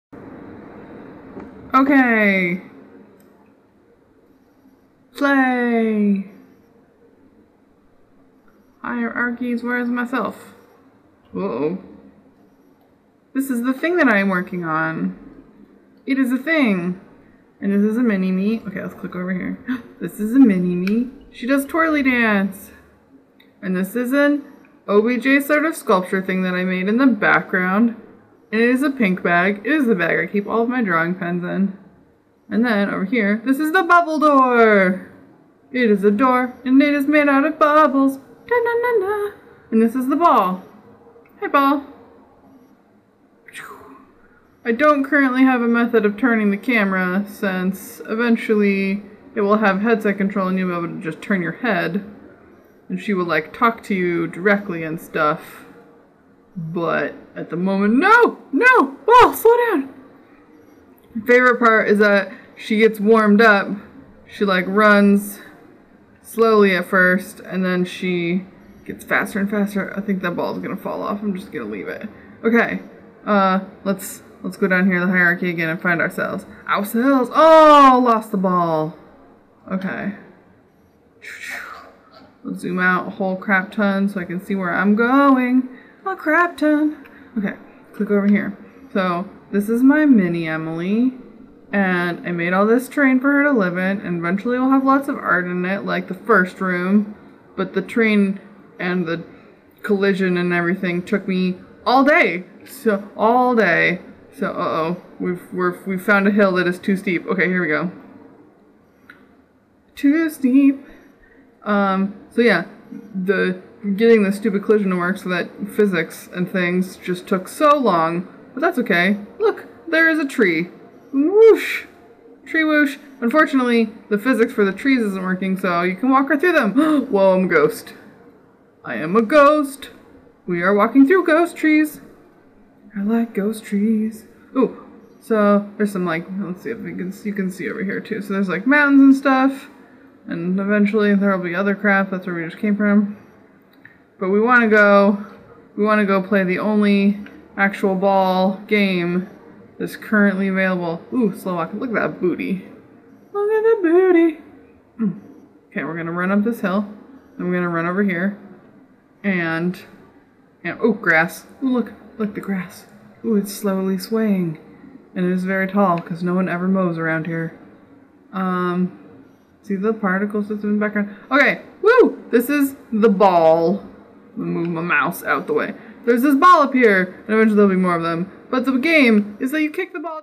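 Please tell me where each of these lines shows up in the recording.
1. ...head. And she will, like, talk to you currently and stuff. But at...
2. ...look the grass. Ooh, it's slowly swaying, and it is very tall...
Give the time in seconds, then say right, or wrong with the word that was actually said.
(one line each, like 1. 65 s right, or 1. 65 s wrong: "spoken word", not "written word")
1. 51 s wrong: "directly", not "currently"
2. 162 s right.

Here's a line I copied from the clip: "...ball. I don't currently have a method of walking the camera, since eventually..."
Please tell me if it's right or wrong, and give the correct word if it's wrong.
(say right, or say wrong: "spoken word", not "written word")
wrong: "turning", not "walking".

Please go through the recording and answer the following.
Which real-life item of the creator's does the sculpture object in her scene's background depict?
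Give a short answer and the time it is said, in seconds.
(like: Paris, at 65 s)
pink bag, at 28 s.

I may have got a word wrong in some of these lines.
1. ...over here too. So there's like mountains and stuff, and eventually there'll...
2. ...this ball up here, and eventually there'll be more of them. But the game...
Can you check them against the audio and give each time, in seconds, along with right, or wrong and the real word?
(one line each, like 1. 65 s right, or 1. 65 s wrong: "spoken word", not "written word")
1. 137 s right
2. 176 s right.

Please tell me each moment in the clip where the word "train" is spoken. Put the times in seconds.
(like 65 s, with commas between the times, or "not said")
92 s, 97 s.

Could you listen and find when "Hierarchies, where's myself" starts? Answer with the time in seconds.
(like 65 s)
8 s.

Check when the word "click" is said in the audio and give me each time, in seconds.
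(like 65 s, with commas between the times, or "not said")
18 s, 87 s.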